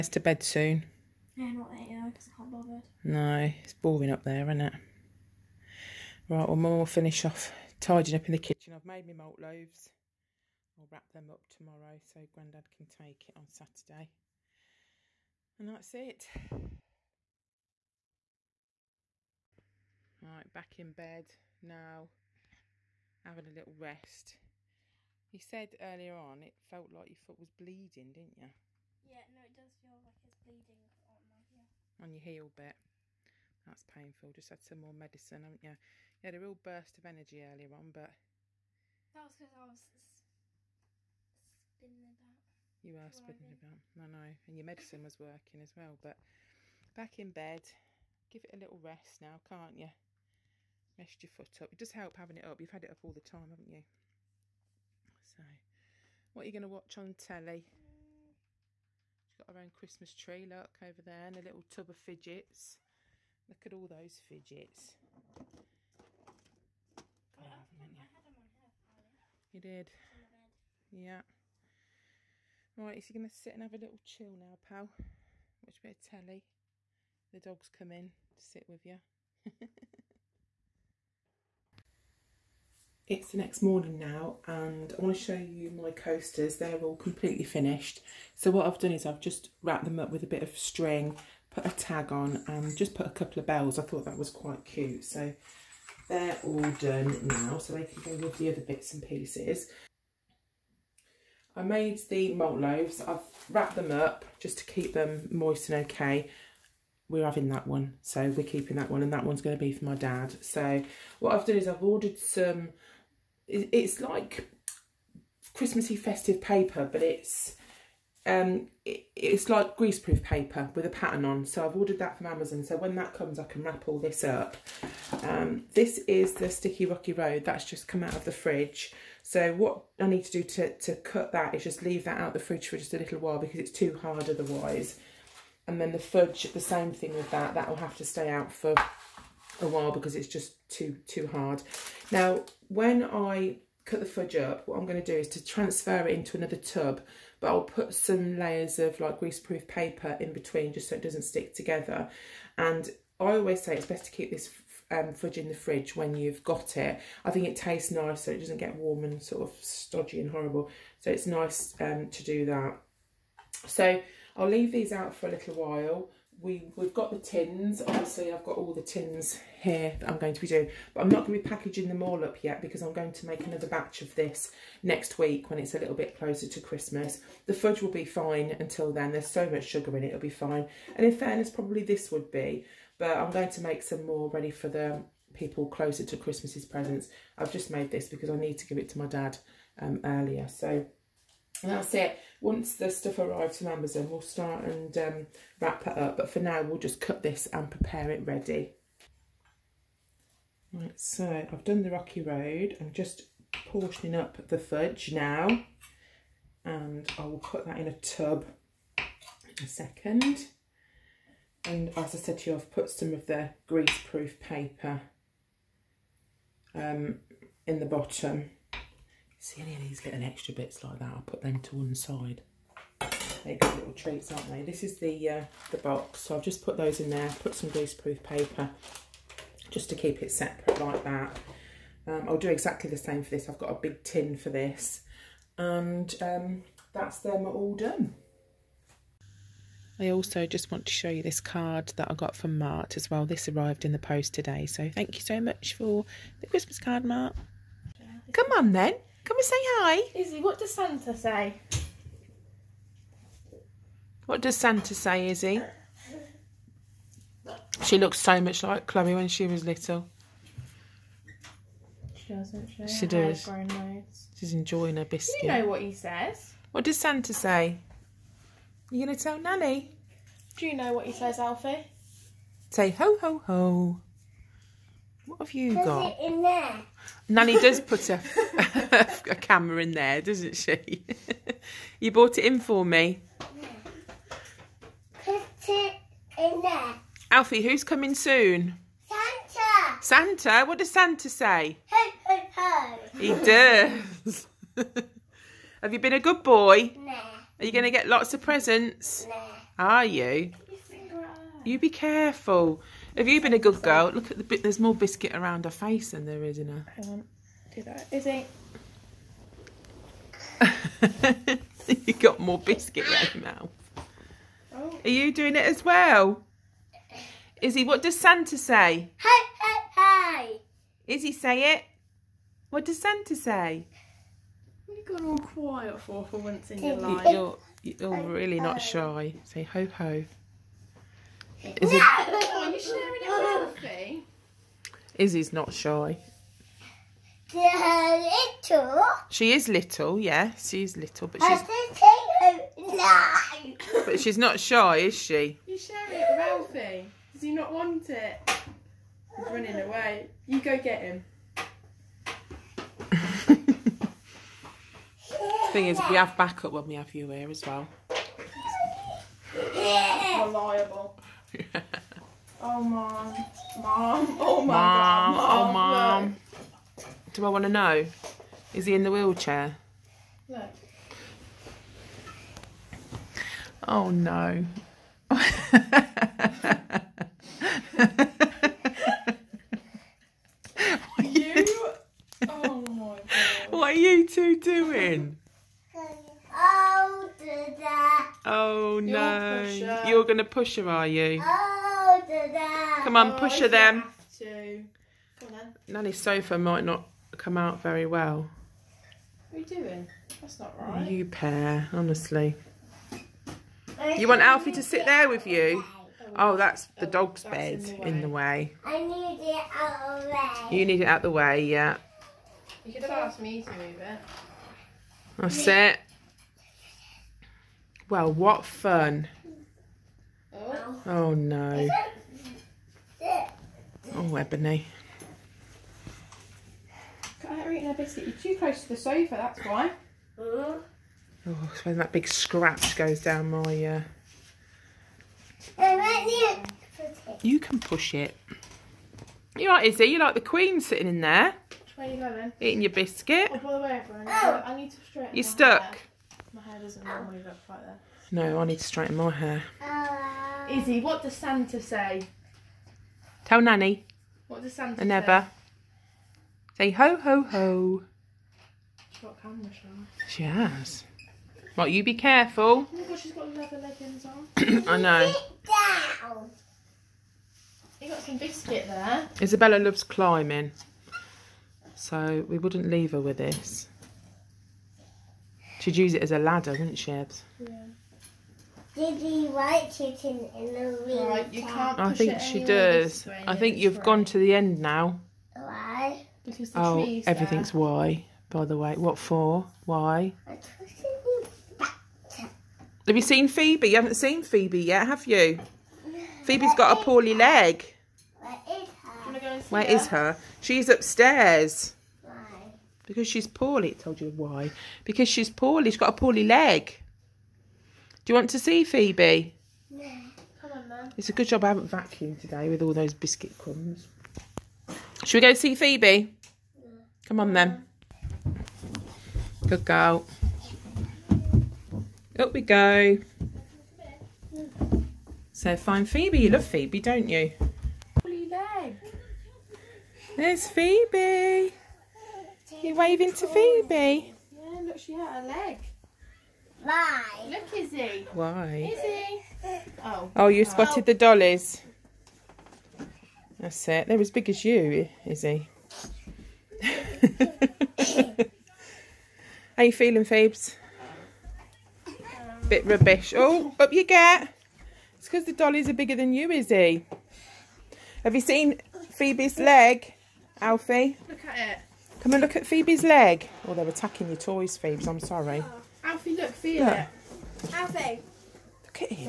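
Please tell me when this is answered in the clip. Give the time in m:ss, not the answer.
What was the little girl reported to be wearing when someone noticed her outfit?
7:43.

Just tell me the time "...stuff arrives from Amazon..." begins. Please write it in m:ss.
3:12.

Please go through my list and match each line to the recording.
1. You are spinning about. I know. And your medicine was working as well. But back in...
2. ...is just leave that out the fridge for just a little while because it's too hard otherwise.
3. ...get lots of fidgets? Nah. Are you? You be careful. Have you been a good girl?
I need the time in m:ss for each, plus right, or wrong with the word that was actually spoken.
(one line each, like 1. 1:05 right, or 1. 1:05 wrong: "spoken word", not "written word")
1. 0:42 right
2. 2:11 right
3. 4:57 wrong: "presents", not "fidgets".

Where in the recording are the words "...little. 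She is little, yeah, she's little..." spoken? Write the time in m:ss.
5:38.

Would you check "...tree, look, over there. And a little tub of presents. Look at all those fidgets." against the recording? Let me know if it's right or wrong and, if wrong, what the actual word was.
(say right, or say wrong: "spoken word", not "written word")
wrong: "fidgets", not "presents".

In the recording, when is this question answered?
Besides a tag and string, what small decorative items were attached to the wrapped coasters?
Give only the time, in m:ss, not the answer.
1:33.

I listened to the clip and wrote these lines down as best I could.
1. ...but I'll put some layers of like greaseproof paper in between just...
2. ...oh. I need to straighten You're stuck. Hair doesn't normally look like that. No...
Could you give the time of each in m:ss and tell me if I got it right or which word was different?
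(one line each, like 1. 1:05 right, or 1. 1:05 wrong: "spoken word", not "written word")
1. 2:27 right
2. 7:24 right.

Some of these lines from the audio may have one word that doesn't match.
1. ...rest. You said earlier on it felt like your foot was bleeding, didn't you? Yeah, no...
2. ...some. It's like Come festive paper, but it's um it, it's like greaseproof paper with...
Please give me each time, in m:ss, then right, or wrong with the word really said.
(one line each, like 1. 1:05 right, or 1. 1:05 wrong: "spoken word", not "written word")
1. 0:23 right
2. 1:52 wrong: "Christmassy", not "Come".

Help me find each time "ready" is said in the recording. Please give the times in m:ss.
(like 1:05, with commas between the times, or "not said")
3:04, 3:18.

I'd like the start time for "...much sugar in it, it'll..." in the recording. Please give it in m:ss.
2:59.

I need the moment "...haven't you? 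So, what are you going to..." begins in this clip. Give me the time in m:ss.
0:53.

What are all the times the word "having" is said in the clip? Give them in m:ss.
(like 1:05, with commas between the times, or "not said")
0:23, 0:52, 1:47.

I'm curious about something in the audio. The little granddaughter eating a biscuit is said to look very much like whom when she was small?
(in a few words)
Chloe.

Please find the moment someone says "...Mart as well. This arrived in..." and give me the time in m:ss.
4:02.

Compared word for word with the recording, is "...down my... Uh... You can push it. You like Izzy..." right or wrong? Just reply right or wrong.
right.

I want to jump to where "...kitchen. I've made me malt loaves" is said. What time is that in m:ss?
0:08.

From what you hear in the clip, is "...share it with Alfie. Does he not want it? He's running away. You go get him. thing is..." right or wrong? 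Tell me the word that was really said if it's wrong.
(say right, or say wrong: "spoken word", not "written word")
right.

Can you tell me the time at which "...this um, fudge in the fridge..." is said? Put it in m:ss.
2:34.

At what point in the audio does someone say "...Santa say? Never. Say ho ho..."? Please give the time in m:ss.
7:34.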